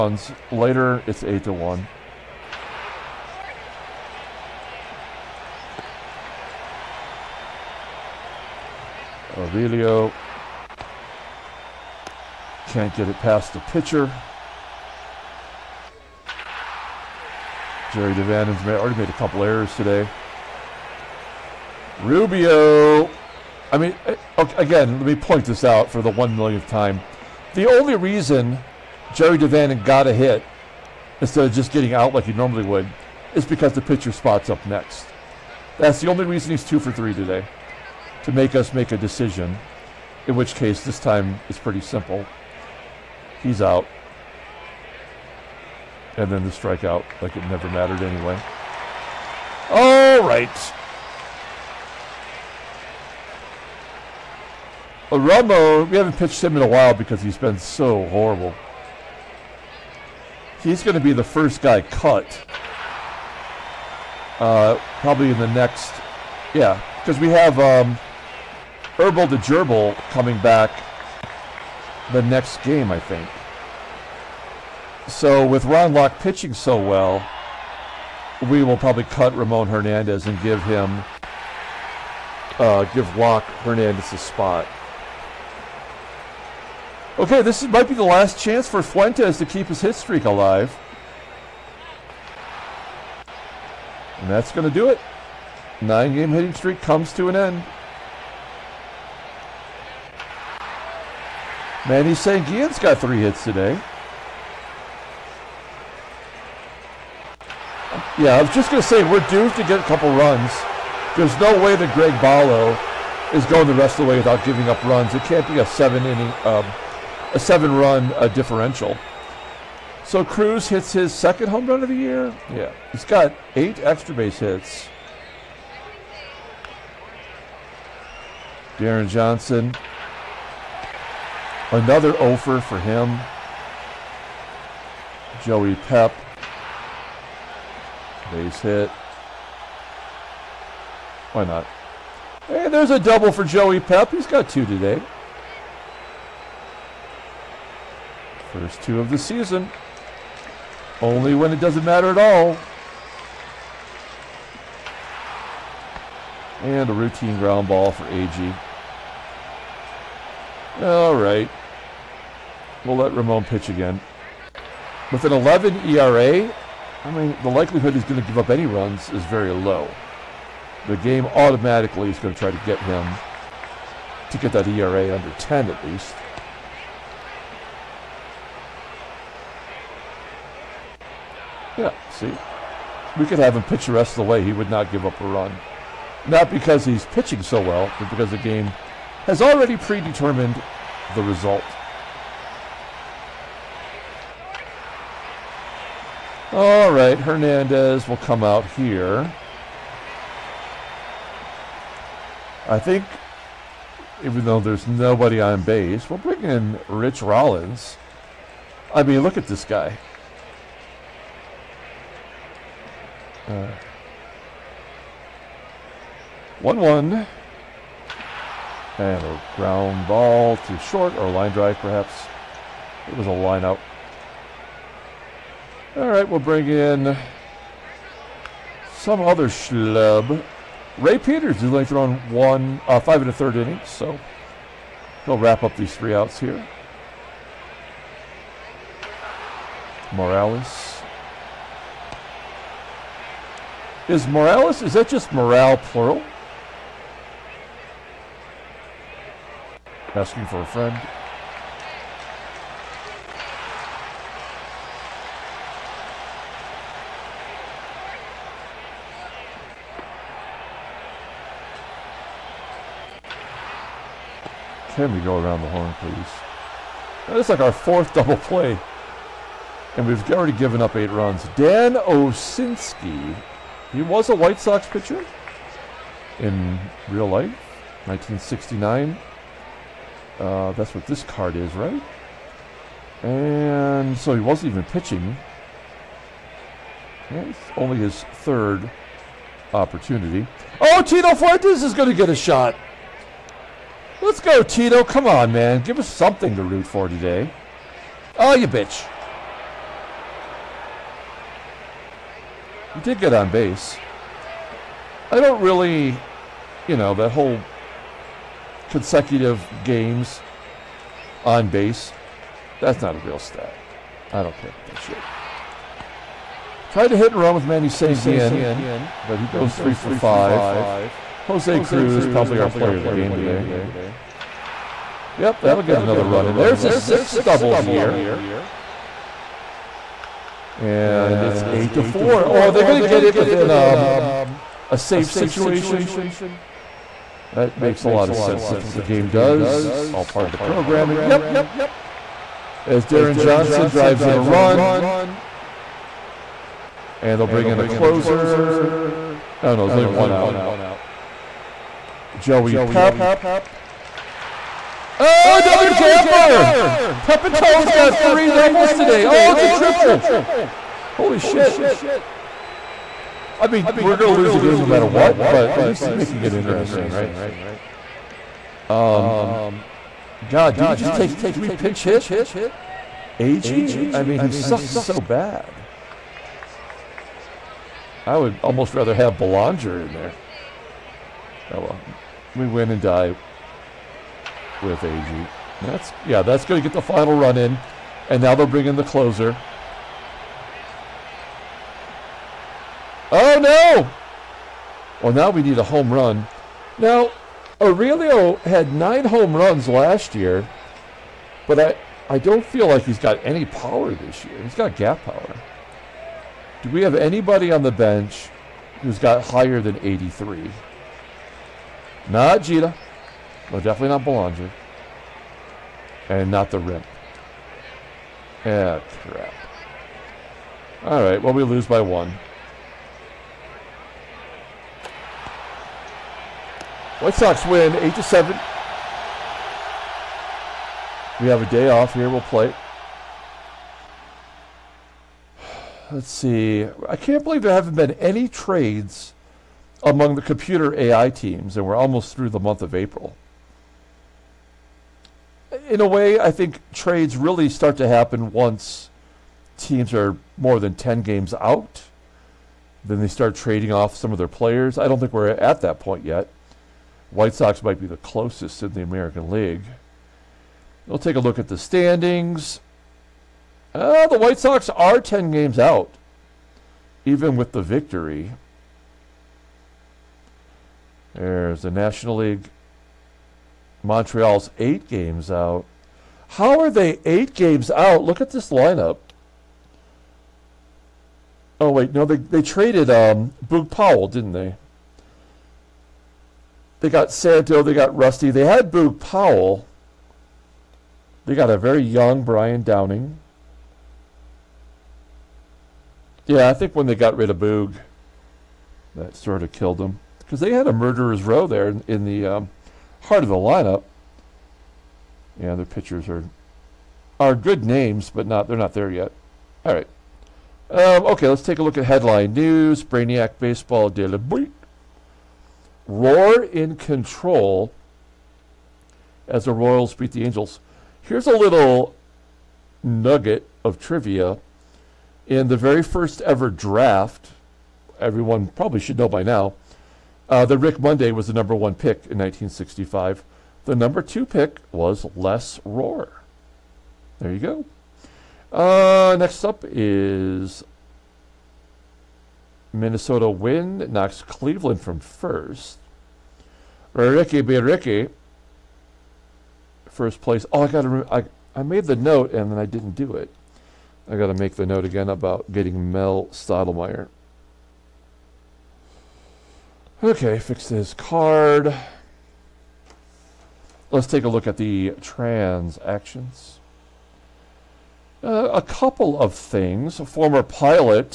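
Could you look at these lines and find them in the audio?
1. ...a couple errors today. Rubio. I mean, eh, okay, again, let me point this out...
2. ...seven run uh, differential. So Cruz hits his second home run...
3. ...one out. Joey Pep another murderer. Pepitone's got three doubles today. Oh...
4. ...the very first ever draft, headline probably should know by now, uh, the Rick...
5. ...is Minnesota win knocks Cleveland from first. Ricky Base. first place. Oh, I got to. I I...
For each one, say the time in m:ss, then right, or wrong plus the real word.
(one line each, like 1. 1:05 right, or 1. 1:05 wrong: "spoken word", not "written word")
1. 0:19 right
2. 1:57 right
3. 5:50 wrong: "gapper", not "murderer"
4. 8:45 wrong: "everyone", not "headline"
5. 8:59 wrong: "Ricky", not "Base".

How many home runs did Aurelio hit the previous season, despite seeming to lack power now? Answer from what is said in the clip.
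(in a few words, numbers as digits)
9.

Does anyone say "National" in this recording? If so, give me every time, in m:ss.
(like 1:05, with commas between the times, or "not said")
7:51.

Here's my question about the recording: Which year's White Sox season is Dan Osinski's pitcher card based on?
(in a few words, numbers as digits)
1969.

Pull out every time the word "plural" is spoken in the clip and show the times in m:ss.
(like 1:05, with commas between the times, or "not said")
4:05.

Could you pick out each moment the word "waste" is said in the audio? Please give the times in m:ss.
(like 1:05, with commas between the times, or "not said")
not said.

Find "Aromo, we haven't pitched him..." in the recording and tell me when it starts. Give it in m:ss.
0:55.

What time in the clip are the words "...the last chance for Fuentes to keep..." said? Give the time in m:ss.
1:27.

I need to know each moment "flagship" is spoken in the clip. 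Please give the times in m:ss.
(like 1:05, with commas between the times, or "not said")
not said.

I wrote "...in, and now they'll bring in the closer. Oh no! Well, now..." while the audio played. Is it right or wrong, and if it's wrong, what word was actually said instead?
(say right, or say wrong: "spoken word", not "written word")
right.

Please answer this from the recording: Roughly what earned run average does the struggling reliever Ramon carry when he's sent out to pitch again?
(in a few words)
11.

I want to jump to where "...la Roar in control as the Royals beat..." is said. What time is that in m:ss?
8:34.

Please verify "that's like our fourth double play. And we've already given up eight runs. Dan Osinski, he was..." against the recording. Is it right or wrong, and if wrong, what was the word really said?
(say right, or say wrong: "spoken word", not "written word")
right.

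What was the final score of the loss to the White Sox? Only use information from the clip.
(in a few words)
8 to 7.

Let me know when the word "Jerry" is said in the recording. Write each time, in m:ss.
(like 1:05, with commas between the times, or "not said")
0:17, 0:29.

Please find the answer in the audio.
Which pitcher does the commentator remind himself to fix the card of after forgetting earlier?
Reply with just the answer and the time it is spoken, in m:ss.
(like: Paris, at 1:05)
Mel Stottlemyre, at 9:16.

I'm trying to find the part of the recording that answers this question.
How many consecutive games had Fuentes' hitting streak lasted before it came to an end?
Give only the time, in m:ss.
1:35.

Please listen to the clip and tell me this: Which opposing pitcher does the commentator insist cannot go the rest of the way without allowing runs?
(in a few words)
Greg Bollo.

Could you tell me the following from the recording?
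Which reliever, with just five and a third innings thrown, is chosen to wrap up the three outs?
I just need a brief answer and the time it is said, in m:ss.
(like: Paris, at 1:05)
Ray Peters, at 3:50.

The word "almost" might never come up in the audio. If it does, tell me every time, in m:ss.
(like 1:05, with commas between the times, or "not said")
6:18, 7:21.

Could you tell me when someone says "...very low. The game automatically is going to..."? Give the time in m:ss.
2:49.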